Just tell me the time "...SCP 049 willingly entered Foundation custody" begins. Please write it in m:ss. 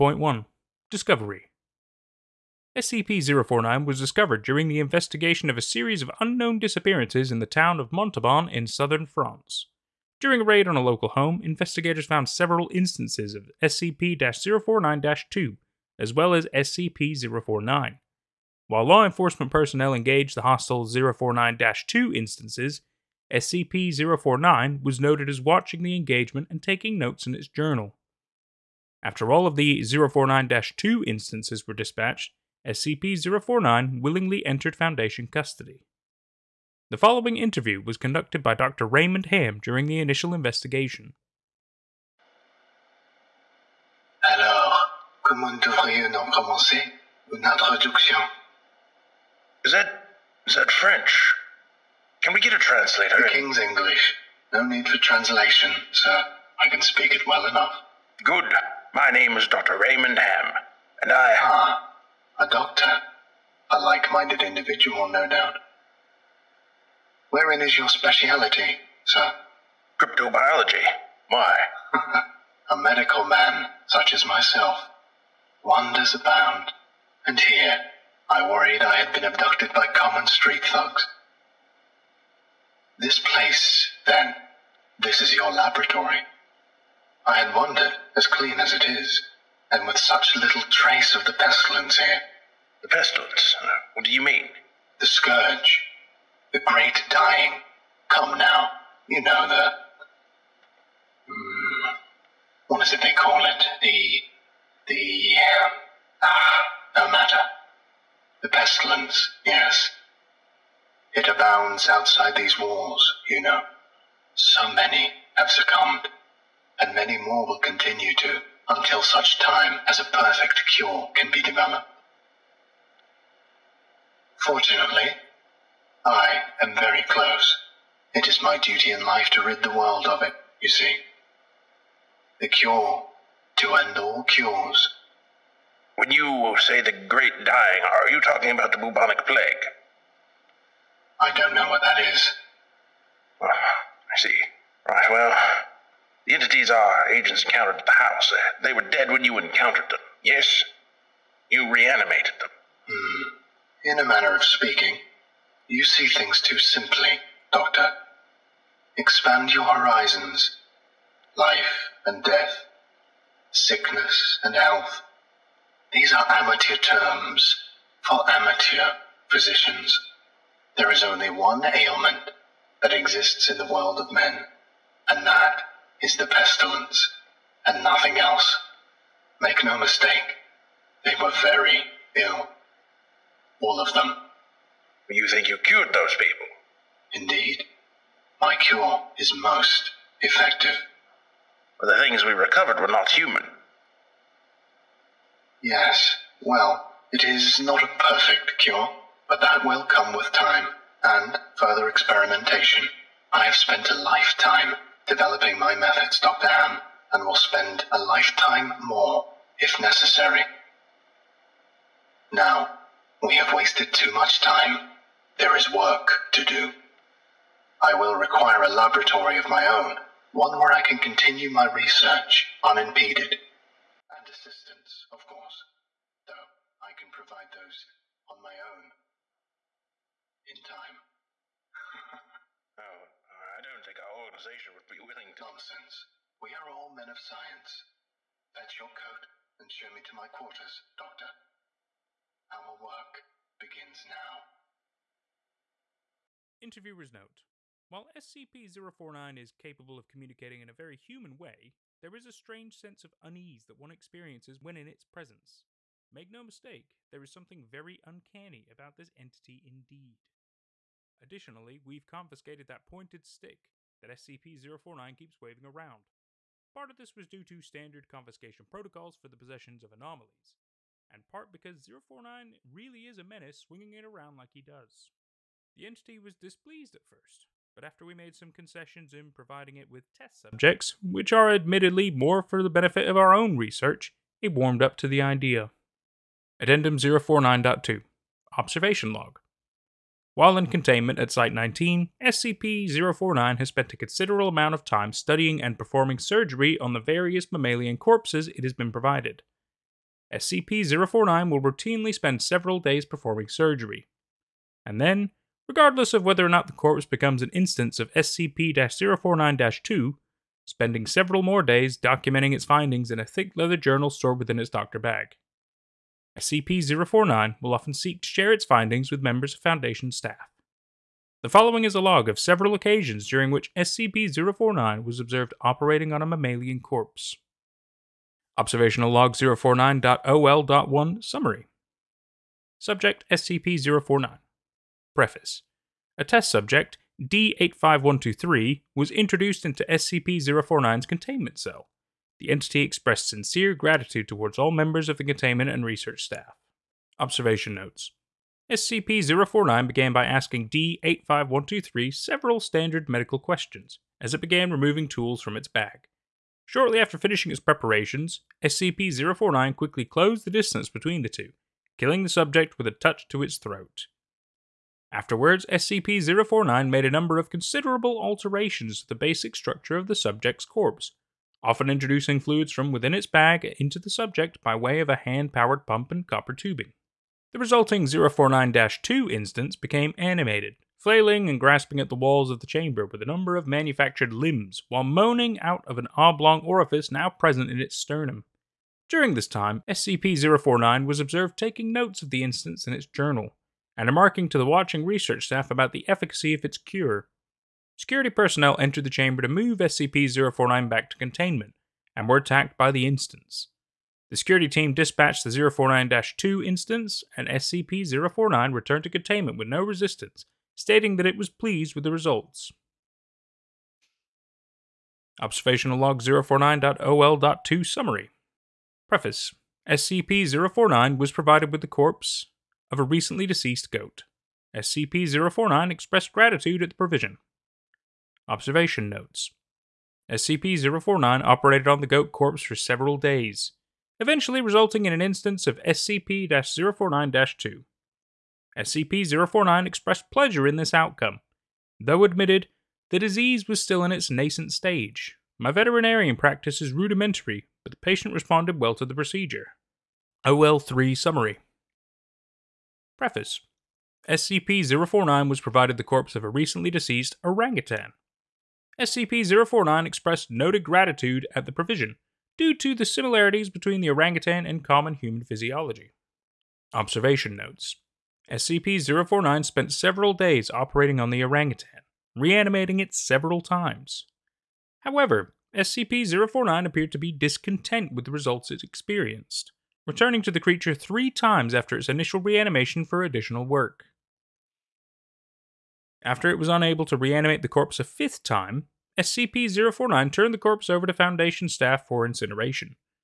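0:32.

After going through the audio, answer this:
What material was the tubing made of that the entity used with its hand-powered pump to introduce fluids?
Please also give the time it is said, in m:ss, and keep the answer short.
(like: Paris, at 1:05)
Copper, at 6:16.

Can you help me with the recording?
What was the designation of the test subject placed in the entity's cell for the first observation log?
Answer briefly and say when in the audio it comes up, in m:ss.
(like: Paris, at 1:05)
D-85123, at 5:37.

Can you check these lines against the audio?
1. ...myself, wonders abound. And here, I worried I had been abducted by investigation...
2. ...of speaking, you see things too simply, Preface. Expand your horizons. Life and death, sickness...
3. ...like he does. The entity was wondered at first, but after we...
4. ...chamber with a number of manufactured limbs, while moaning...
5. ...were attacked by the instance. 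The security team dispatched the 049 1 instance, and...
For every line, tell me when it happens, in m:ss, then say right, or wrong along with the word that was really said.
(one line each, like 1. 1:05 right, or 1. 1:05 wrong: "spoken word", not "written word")
1. 1:14 wrong: "common", not "investigation"
2. 2:34 wrong: "Doctor", not "Preface"
3. 4:34 wrong: "displeased", not "wondered"
4. 6:22 right
5. 6:42 wrong: "2", not "1".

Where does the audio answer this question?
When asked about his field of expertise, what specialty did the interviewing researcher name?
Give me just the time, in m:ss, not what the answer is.
1:09.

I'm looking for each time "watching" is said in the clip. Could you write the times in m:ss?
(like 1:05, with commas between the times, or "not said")
0:25, 6:34.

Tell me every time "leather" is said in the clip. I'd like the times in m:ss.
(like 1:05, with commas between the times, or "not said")
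5:13.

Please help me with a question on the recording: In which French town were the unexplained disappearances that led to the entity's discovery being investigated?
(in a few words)
Montauban.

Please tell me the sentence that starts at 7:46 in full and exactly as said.
Observation notes SCP-049 spent several days operating on the orangutan, reanimating it several times.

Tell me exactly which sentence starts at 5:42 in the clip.
The entity expressed sincere gratitude towards all members of the containment and research staff.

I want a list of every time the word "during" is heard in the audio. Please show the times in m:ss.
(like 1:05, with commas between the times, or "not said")
0:04, 0:10, 0:39, 5:23, 6:29.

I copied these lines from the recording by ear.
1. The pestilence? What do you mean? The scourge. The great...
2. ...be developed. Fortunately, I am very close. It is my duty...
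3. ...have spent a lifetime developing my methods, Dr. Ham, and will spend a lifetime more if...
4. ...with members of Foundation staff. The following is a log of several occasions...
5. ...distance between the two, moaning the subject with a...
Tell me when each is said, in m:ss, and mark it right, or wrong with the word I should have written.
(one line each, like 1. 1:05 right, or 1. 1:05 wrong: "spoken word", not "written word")
1. 1:32 right
2. 2:01 right
3. 3:23 right
4. 5:19 right
5. 6:00 wrong: "killing", not "moaning".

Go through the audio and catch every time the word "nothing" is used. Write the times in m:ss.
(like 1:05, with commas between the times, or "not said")
2:57.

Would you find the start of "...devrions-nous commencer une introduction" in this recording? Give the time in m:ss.
0:45.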